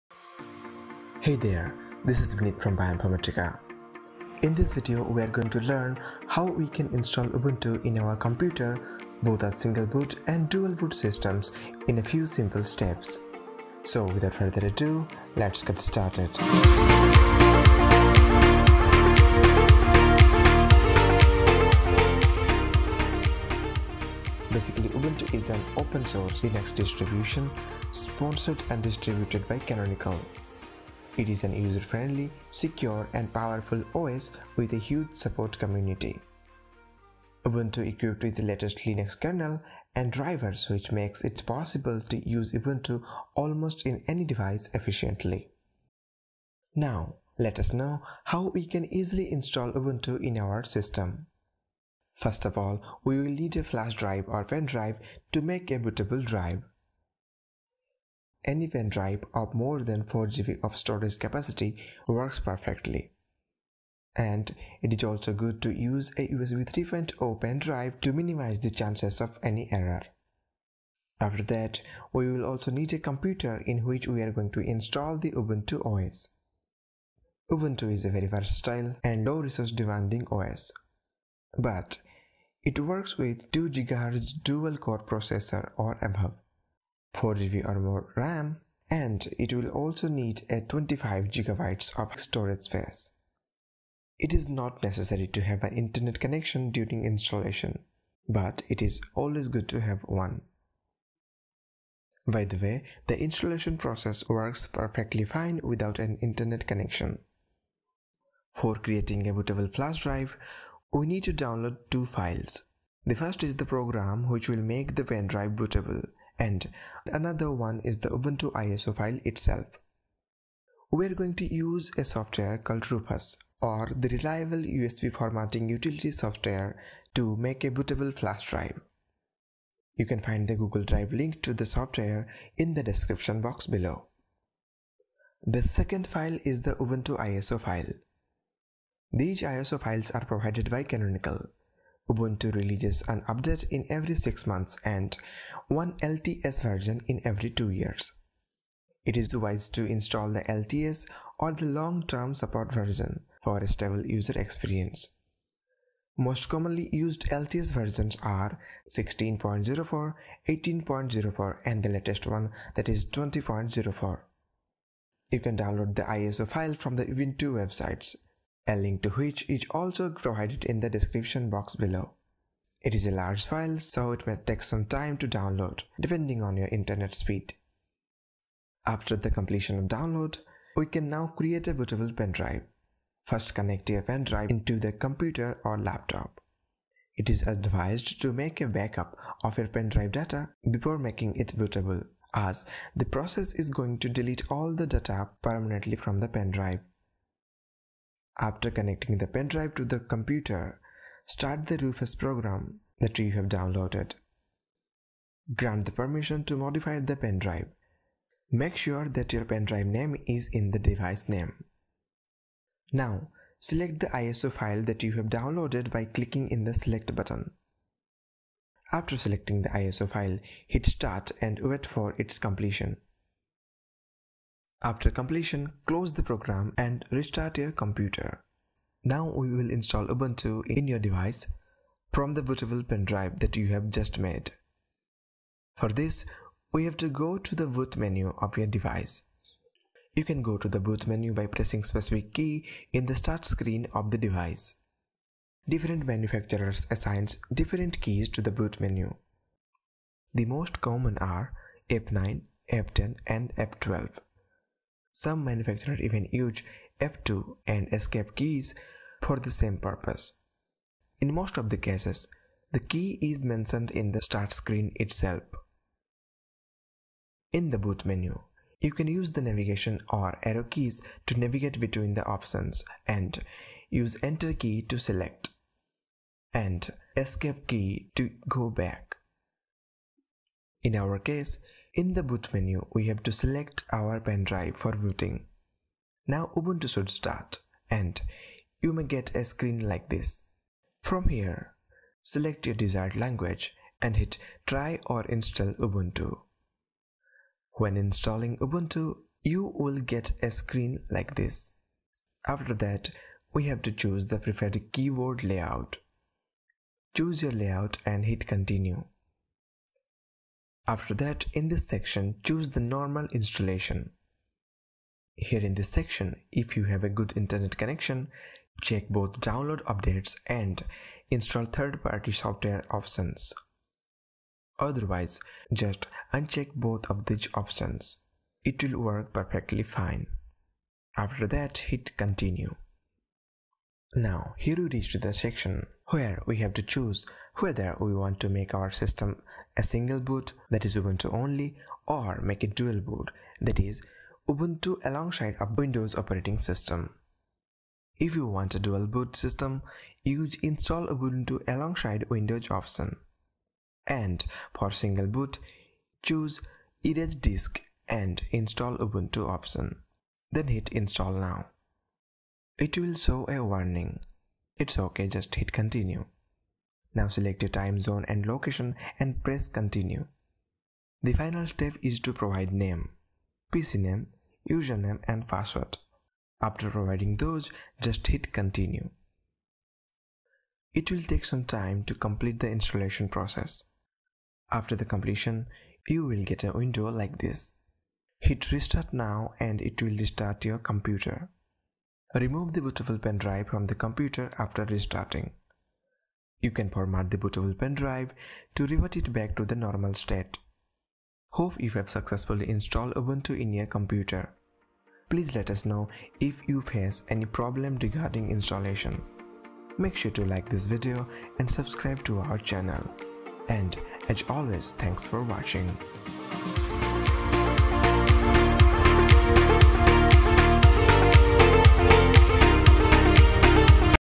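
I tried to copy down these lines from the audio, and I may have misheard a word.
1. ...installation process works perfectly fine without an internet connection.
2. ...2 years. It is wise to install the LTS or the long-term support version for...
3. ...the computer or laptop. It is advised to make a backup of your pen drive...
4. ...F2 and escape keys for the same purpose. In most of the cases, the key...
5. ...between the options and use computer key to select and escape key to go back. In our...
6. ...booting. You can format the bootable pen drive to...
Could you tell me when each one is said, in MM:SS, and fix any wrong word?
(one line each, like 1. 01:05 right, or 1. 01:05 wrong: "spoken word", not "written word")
1. 01:43 right
2. 02:27 right
3. 03:04 right
4. 04:17 right
5. 04:31 wrong: "enter", not "computer"
6. 06:34 wrong: "restarting", not "booting".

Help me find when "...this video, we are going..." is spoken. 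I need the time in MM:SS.
00:04.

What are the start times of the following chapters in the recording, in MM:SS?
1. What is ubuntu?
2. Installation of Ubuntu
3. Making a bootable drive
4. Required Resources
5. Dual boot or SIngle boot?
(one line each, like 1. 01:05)
1. 00:24
2. 04:45
3. 02:58
4. 00:51
5. 05:33.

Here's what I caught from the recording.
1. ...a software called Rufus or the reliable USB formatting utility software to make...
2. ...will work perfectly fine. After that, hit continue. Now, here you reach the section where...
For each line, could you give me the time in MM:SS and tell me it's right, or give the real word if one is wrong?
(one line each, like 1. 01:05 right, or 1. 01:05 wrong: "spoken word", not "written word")
1. 02:01 right
2. 05:28 right.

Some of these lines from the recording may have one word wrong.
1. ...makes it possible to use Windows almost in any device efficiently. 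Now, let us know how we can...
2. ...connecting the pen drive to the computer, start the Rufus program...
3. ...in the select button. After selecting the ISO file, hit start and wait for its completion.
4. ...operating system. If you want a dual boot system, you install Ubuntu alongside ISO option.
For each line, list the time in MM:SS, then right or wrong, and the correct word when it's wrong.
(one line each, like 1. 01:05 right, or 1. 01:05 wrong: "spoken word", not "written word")
1. 00:40 wrong: "Ubuntu", not "Windows"
2. 03:18 right
3. 03:36 right
4. 05:46 wrong: "Windows", not "ISO".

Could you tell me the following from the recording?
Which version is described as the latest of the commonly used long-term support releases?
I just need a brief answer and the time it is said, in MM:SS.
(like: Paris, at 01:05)
20.04, at 02:43.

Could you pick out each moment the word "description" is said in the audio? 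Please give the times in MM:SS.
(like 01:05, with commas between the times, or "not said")
02:12, 02:50.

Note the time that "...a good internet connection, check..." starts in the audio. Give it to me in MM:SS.
05:17.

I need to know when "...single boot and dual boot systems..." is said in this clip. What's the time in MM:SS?
00:09.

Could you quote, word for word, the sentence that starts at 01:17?
Ubuntu is a very versatile and low resource demanding OS.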